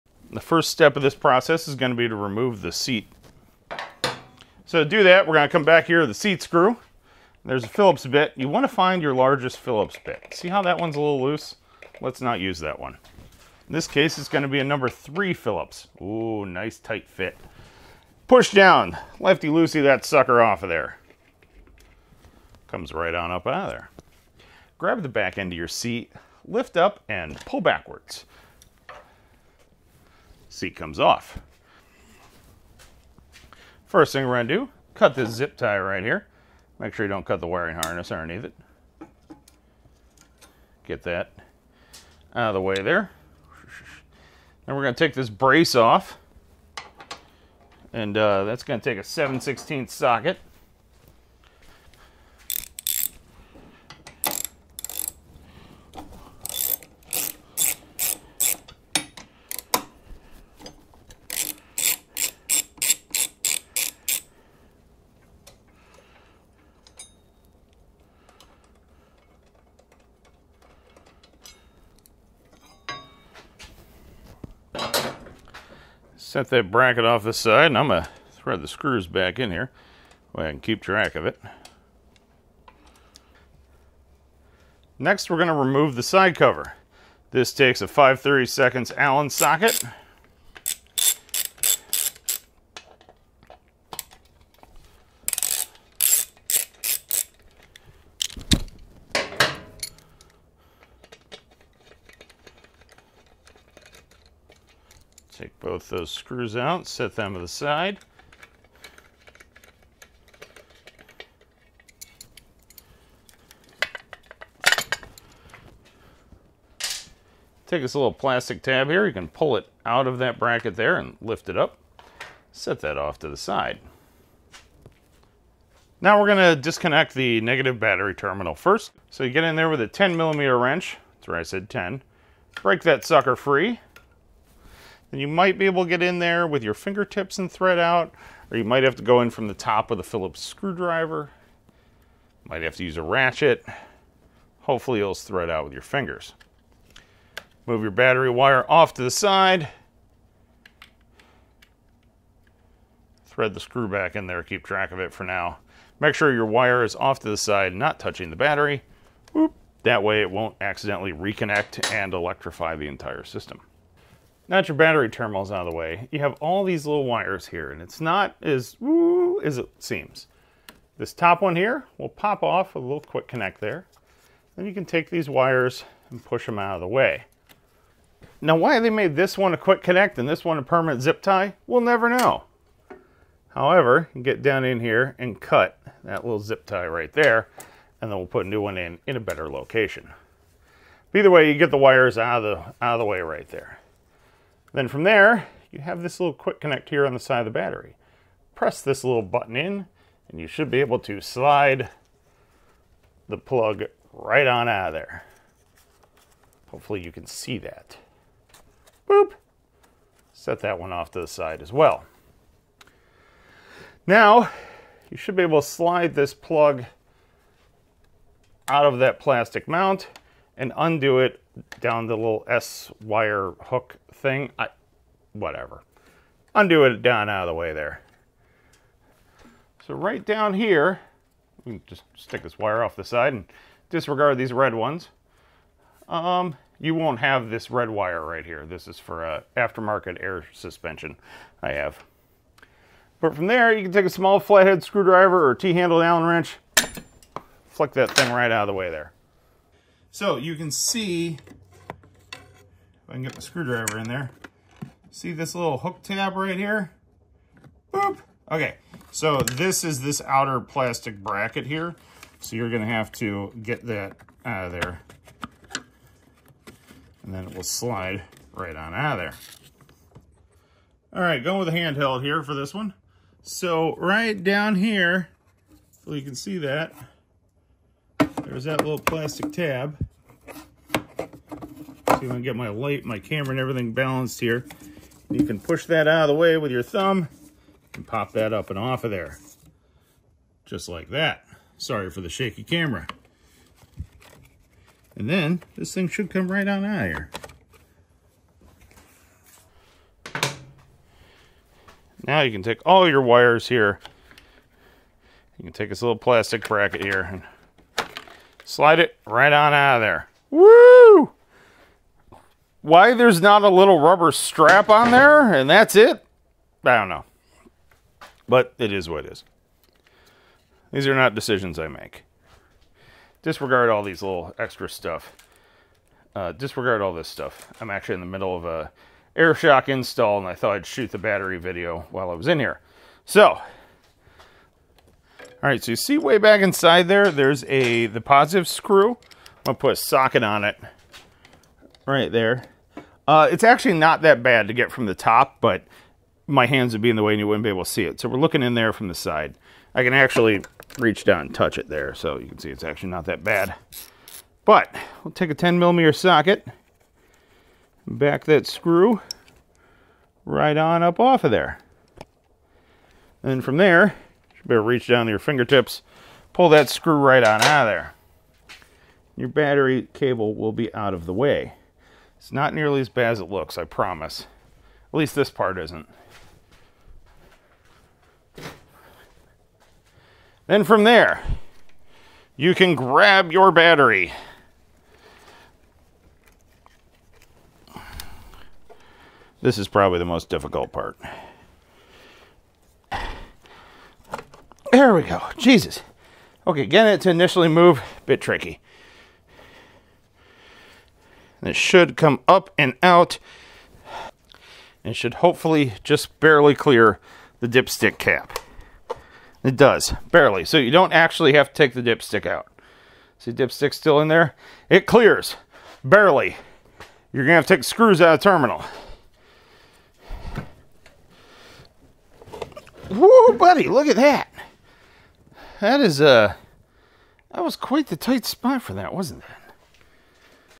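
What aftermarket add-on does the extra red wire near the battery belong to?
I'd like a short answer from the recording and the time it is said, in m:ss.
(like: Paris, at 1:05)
air suspension, at 4:00.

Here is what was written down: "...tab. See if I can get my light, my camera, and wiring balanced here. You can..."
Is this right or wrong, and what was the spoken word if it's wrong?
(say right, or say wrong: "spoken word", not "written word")
wrong: "everything", not "wiring".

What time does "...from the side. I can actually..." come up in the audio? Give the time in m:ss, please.
5:48.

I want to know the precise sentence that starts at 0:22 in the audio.
Comes right on up out of there.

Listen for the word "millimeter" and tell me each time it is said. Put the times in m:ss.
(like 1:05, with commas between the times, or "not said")
2:10, 5:55.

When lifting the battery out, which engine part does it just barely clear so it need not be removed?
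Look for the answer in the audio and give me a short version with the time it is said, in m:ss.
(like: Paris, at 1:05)
dipstick cap, at 6:47.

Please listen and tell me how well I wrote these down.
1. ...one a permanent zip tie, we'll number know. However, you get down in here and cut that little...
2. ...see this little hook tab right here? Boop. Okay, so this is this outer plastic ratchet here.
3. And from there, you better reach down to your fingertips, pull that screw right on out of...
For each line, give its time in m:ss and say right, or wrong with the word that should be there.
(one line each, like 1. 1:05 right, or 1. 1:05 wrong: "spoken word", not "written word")
1. 3:00 wrong: "never", not "number"
2. 4:15 wrong: "bracket", not "ratchet"
3. 6:03 right.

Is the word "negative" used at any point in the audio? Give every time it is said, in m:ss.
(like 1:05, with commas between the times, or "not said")
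2:07.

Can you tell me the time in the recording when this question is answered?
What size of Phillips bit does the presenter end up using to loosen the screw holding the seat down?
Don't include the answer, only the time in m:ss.
0:14.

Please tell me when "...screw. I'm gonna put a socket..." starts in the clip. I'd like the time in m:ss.
5:38.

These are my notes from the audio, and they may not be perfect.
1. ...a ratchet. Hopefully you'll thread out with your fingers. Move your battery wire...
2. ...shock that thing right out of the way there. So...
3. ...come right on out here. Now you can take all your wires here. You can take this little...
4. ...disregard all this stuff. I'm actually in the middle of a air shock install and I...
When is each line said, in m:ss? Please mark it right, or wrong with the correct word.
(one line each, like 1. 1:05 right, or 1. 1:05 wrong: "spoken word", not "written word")
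1. 2:22 right
2. 4:07 wrong: "flick", not "shock"
3. 4:56 right
4. 5:26 right.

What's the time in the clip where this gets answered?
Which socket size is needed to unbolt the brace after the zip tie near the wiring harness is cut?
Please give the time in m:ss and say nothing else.
0:49.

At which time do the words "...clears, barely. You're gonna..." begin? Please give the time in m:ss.
6:55.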